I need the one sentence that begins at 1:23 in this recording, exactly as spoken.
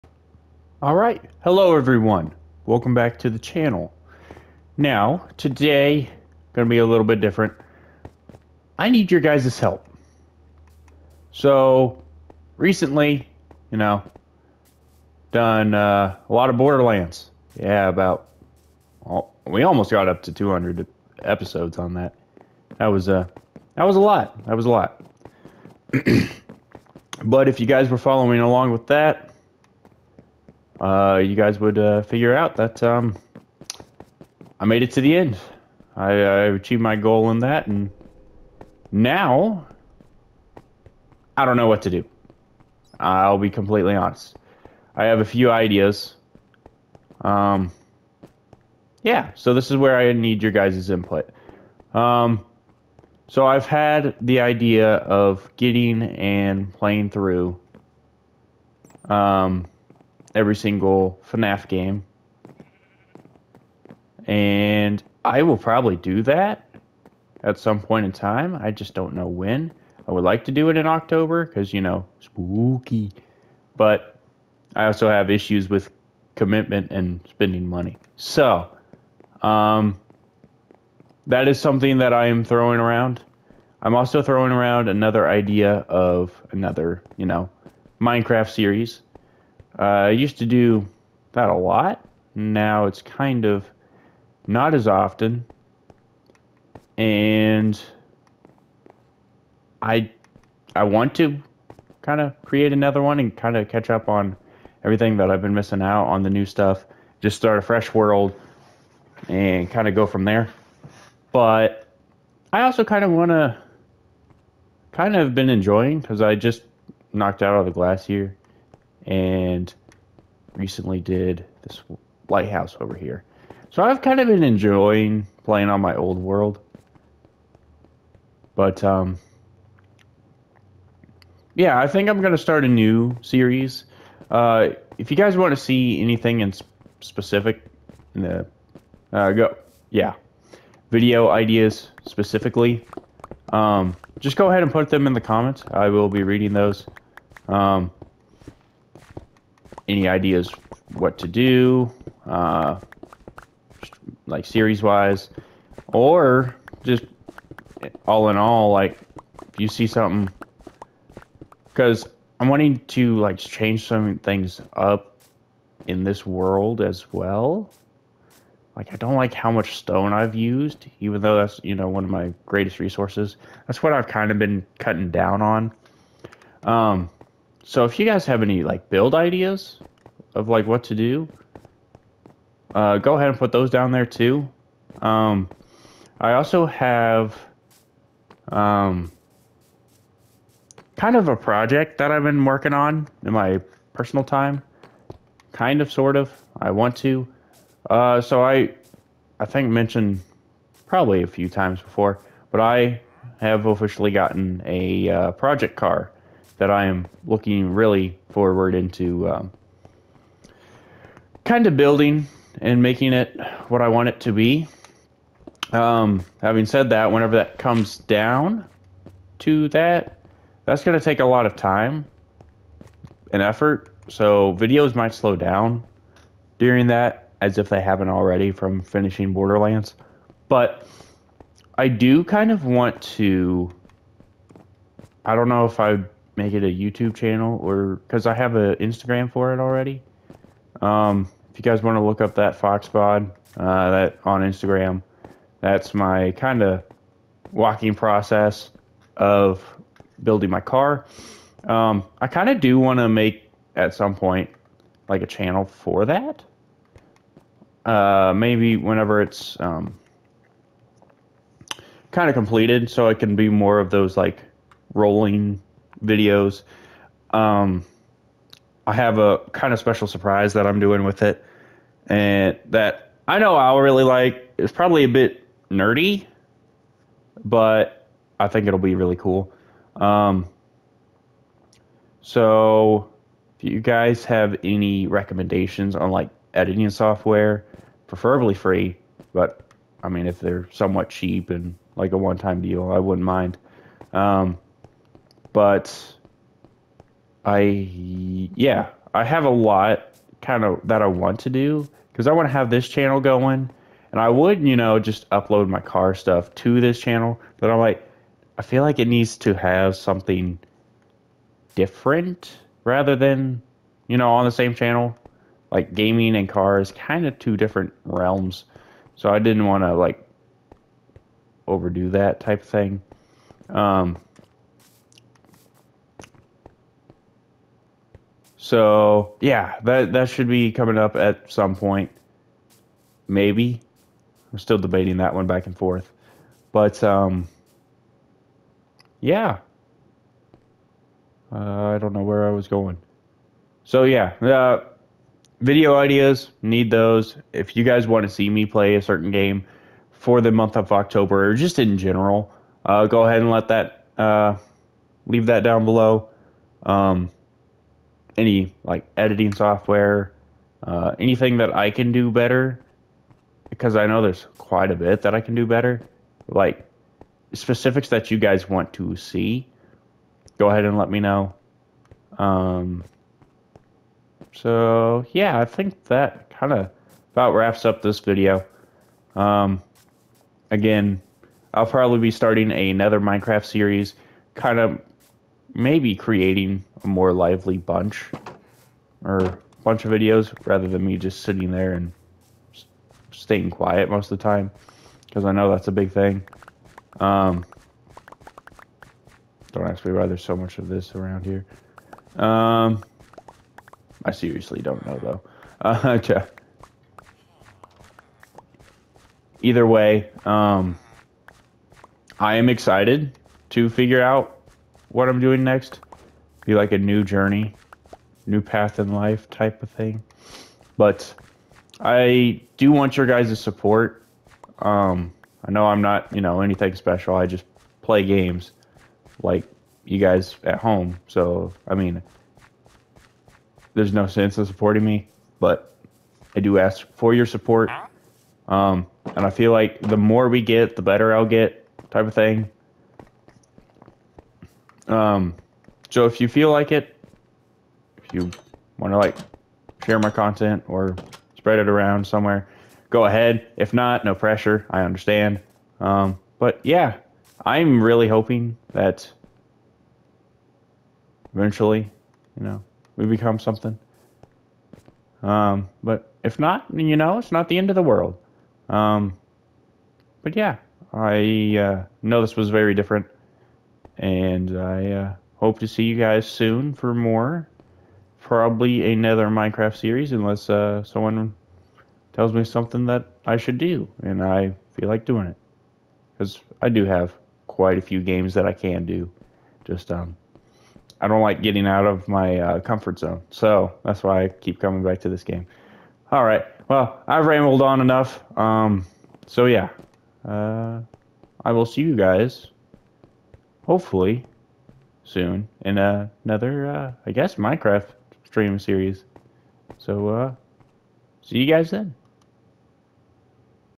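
I'm also throwing around another idea of another, you know, Minecraft series uh, I used to do that a lot.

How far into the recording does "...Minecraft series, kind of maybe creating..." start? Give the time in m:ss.
6:23.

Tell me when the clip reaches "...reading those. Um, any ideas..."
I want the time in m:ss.
2:26.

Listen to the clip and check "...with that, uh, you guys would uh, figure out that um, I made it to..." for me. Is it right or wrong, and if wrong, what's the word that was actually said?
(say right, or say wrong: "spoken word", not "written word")
right.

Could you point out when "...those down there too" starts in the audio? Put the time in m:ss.
3:03.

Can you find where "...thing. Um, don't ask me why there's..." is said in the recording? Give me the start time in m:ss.
6:36.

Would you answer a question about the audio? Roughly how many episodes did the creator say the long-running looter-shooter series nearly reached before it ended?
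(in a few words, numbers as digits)
200.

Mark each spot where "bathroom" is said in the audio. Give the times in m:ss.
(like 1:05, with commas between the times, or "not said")
not said.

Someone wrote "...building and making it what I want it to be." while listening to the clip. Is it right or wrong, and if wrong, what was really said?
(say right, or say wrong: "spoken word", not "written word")
right.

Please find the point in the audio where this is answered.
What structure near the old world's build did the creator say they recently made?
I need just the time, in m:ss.
2:02.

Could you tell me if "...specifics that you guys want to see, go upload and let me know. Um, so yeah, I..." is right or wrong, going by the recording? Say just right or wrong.
wrong.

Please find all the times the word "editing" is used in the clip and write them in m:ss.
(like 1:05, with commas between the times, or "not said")
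4:46, 5:59.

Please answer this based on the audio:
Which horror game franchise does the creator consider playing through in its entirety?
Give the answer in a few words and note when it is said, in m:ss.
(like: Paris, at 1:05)
FNAF, at 1:01.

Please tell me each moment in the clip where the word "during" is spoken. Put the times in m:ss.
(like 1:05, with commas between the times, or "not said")
3:46.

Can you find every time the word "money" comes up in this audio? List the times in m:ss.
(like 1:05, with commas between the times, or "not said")
1:17.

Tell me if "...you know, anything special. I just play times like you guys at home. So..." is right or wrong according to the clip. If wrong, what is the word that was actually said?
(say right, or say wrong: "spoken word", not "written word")
wrong: "games", not "times".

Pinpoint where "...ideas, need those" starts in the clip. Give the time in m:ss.
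5:45.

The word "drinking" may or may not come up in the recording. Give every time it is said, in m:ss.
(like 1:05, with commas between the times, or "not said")
not said.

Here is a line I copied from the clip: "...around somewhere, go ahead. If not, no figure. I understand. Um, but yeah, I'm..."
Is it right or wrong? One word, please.
wrong.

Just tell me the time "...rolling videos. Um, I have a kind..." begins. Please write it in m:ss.
4:24.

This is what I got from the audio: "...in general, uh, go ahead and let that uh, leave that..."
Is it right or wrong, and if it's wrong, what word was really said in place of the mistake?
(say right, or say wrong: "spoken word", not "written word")
right.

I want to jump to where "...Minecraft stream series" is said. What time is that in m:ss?
8:27.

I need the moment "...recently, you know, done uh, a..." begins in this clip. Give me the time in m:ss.
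0:12.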